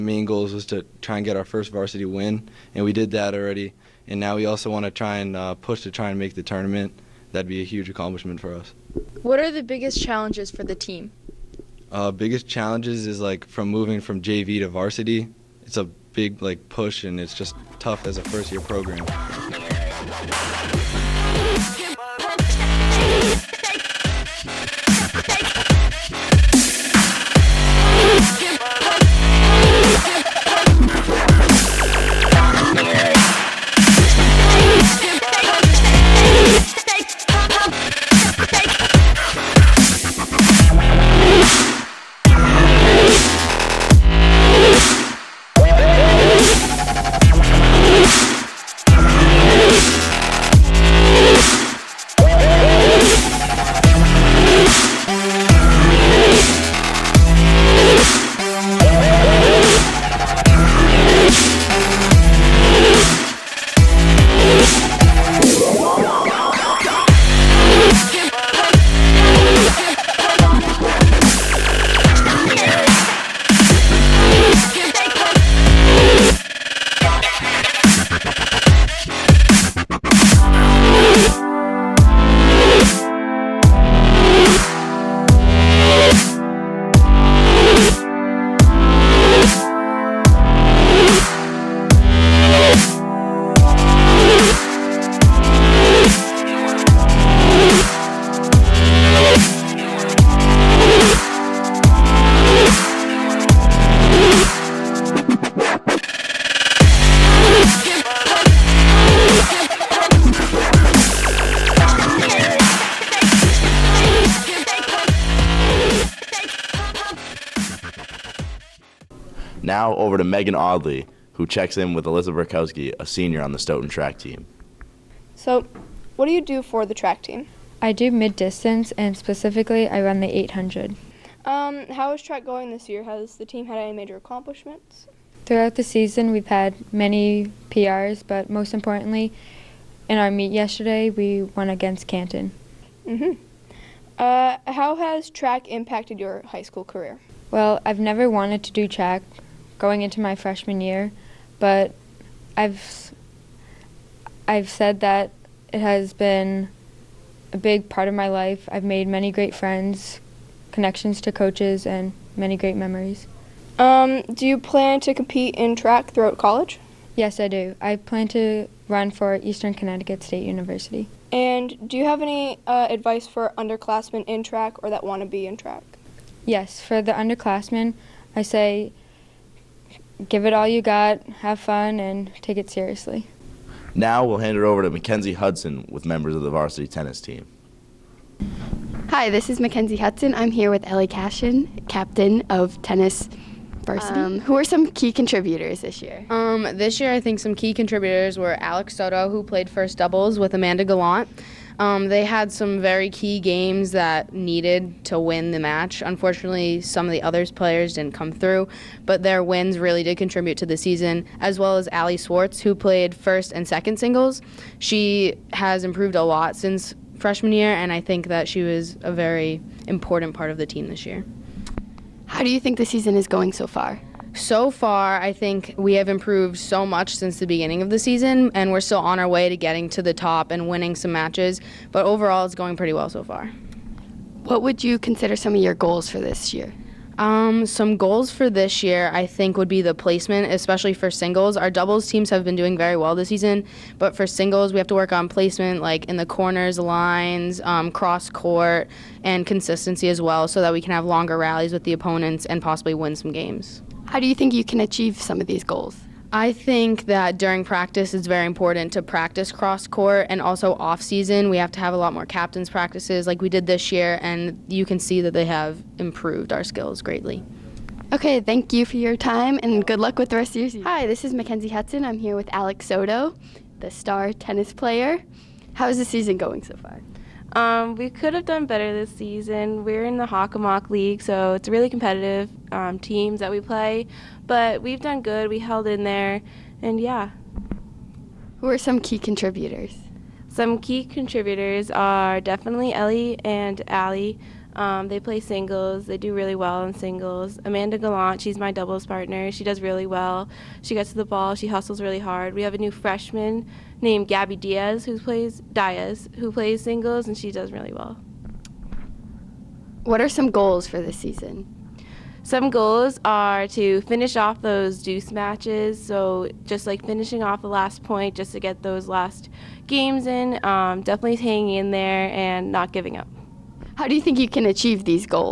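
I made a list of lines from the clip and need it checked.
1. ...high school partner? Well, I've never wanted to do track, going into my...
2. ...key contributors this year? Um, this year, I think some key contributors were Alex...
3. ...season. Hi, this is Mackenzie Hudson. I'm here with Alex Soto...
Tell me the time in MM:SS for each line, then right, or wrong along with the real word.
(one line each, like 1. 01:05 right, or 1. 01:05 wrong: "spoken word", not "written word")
1. 02:26 wrong: "career", not "partner"
2. 03:14 right
3. 04:30 right.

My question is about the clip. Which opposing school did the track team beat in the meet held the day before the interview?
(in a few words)
Canton.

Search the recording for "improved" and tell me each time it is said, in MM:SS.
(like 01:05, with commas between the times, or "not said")
03:35, 03:46, 04:25.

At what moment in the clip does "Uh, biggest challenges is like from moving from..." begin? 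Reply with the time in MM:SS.
00:11.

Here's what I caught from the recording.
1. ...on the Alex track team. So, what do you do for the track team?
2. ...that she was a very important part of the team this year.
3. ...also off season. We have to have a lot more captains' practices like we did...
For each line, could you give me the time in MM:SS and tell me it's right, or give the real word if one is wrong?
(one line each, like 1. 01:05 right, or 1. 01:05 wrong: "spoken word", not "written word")
1. 02:03 wrong: "Stoughton", not "Alex"
2. 03:38 right
3. 04:20 right.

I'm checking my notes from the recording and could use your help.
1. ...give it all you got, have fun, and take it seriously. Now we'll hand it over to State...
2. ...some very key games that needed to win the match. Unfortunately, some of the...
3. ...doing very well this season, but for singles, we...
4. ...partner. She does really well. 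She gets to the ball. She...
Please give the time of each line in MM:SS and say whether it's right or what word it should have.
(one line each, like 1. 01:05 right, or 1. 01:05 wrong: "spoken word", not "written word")
1. 03:00 wrong: "Mackenzie", not "State"
2. 03:22 right
3. 04:02 right
4. 04:59 right.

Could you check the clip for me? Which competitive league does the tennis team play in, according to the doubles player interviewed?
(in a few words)
Hockamock League.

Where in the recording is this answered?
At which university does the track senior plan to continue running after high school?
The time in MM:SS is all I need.
02:49.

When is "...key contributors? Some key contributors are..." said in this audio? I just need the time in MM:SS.
04:48.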